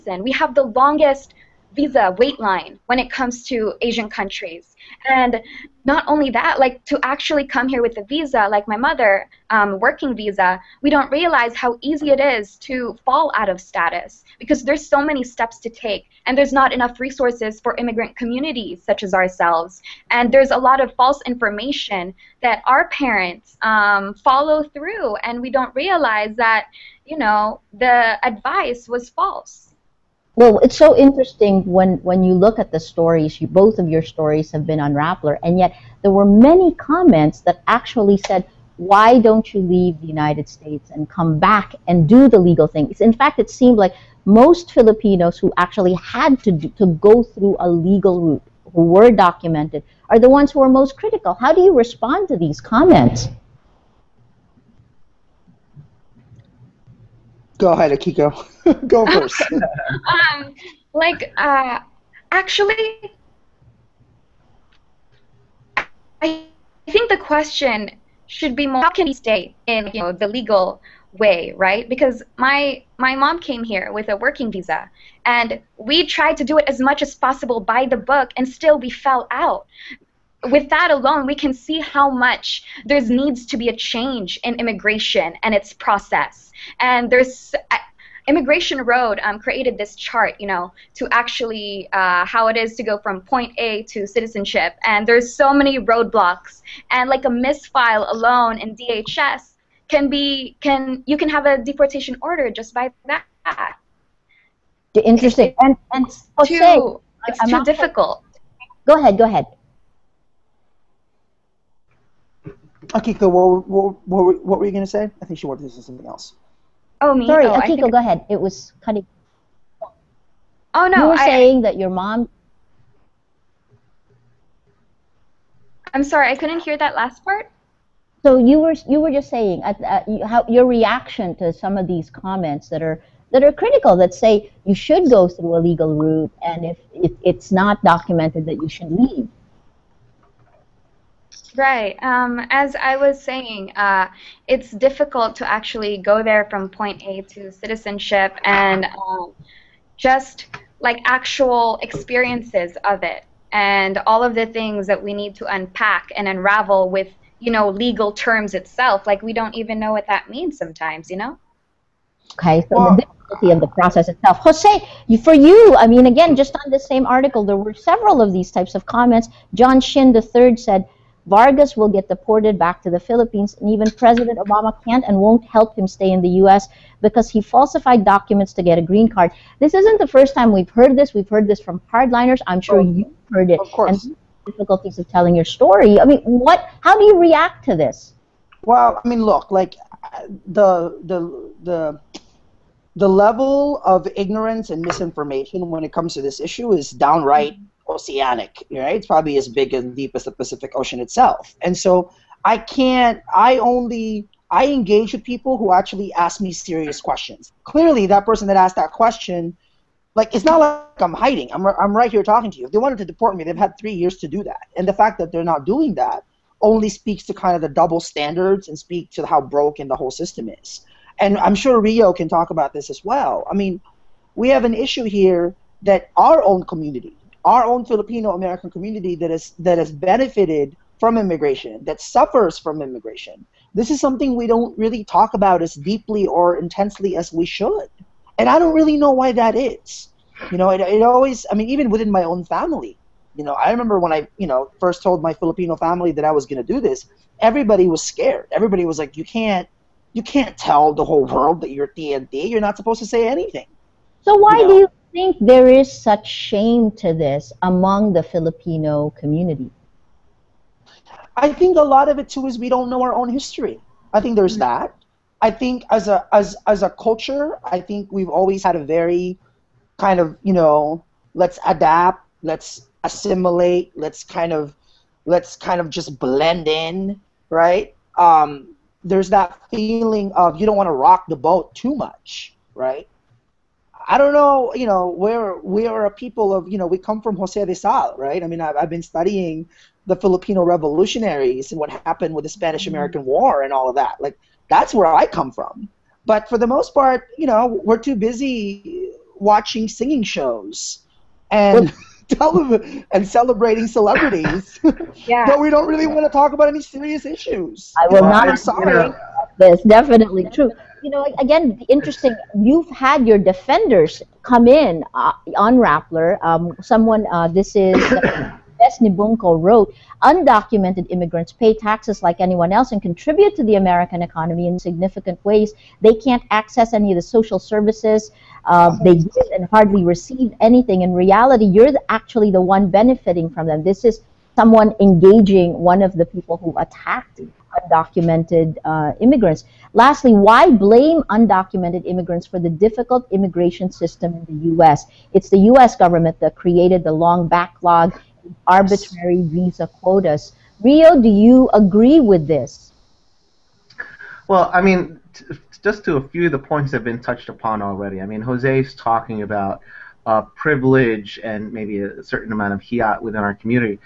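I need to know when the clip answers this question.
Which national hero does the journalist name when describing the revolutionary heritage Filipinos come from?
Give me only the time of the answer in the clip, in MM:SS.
04:47.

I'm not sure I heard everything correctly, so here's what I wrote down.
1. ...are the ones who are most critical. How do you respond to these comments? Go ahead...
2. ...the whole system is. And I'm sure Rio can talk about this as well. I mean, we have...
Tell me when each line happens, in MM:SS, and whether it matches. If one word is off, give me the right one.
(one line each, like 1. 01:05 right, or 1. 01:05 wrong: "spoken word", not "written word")
1. 00:50 right
2. 03:39 right.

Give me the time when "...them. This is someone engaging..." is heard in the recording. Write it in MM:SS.
05:33.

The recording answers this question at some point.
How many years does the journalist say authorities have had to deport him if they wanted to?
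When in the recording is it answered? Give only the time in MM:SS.
03:33.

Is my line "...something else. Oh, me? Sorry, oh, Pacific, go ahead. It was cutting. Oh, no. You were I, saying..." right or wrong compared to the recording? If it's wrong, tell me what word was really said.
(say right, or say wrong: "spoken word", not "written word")
wrong: "Akiko", not "Pacific".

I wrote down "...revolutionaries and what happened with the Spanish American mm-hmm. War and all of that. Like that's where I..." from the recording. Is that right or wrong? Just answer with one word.
right.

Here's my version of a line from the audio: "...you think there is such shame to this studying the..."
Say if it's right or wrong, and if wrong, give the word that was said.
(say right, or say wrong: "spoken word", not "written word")
wrong: "among", not "studying".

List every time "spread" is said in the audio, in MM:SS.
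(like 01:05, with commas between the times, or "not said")
not said.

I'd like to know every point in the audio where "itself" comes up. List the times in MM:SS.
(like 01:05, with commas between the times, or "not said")
02:38, 02:44, 03:21.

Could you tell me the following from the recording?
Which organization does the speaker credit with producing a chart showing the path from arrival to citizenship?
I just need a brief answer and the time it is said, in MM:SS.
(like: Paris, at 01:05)
Immigration Road, at 01:28.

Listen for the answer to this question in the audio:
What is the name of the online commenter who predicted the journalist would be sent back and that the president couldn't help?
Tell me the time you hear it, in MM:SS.
02:49.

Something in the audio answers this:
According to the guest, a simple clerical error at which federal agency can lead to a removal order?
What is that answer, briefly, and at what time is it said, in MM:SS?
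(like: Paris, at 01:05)
DHS, at 01:38.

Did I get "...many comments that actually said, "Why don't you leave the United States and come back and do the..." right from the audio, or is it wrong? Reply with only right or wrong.
right.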